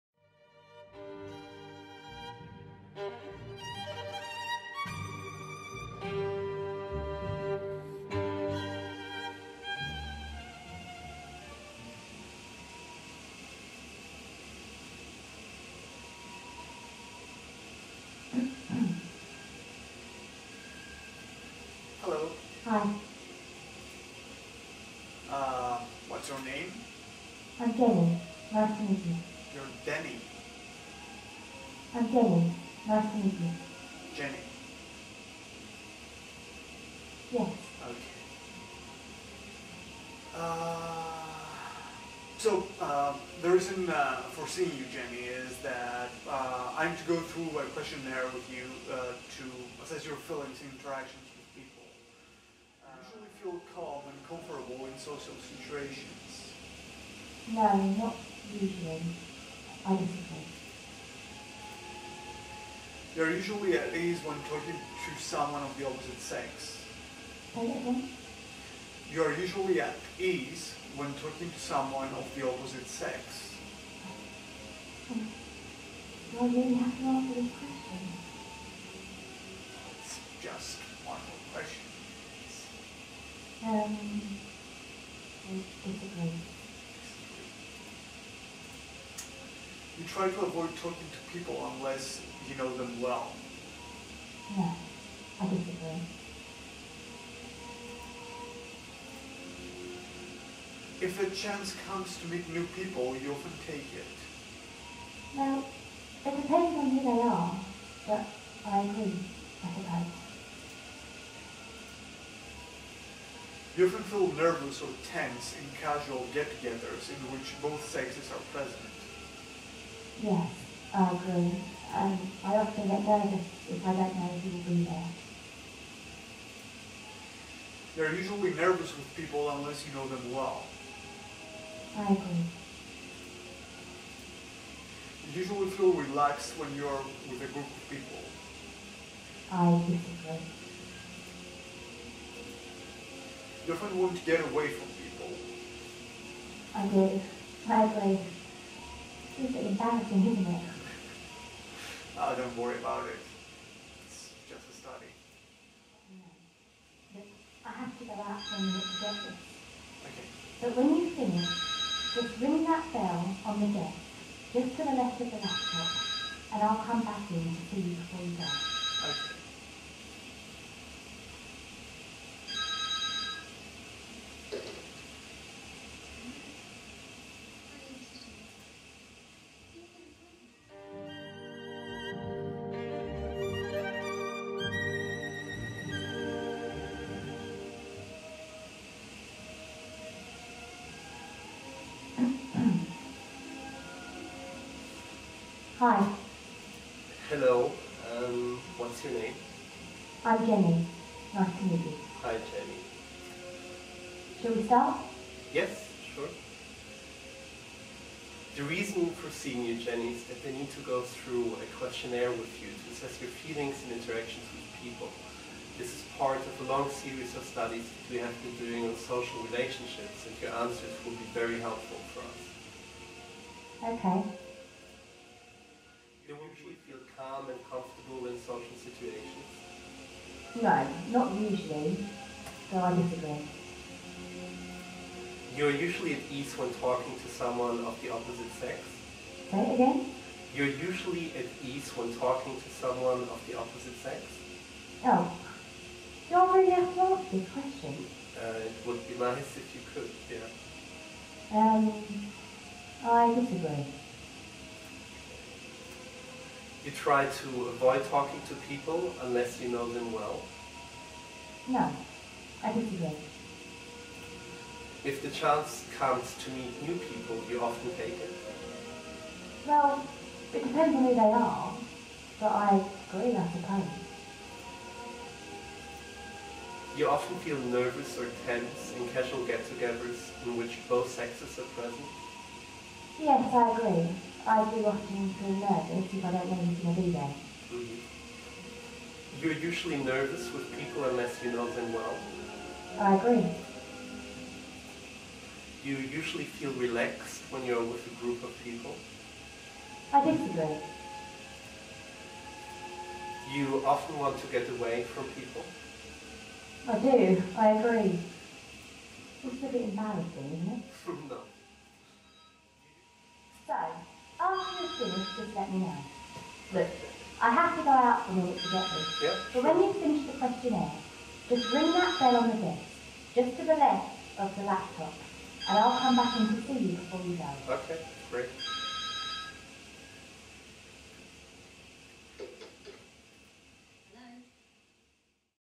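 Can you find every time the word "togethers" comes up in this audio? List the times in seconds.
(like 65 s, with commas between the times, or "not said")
116 s, 279 s.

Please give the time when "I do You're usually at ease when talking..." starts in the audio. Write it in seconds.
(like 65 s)
59 s.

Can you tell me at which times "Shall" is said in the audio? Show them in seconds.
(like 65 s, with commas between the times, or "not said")
204 s.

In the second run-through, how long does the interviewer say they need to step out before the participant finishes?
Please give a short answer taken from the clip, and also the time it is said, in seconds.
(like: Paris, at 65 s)
a minute, at 318 s.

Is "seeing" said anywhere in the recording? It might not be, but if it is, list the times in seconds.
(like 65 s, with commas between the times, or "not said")
44 s, 209 s.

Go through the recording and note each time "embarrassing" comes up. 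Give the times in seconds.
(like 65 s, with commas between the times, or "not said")
149 s, 309 s.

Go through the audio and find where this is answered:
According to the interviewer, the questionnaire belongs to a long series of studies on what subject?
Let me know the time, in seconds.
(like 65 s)
218 s.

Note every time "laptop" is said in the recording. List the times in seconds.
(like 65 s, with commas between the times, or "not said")
165 s, 324 s.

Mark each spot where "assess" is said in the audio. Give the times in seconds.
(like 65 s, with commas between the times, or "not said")
49 s, 212 s.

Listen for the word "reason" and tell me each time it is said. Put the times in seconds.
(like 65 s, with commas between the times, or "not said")
43 s, 208 s.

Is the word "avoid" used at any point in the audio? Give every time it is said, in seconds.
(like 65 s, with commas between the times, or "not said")
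90 s, 257 s.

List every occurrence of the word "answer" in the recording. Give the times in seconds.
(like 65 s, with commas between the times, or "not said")
77 s, 220 s, 247 s.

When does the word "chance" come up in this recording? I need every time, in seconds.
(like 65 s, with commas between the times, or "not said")
101 s, 265 s.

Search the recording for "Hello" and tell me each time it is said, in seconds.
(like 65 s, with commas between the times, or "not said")
22 s, 197 s.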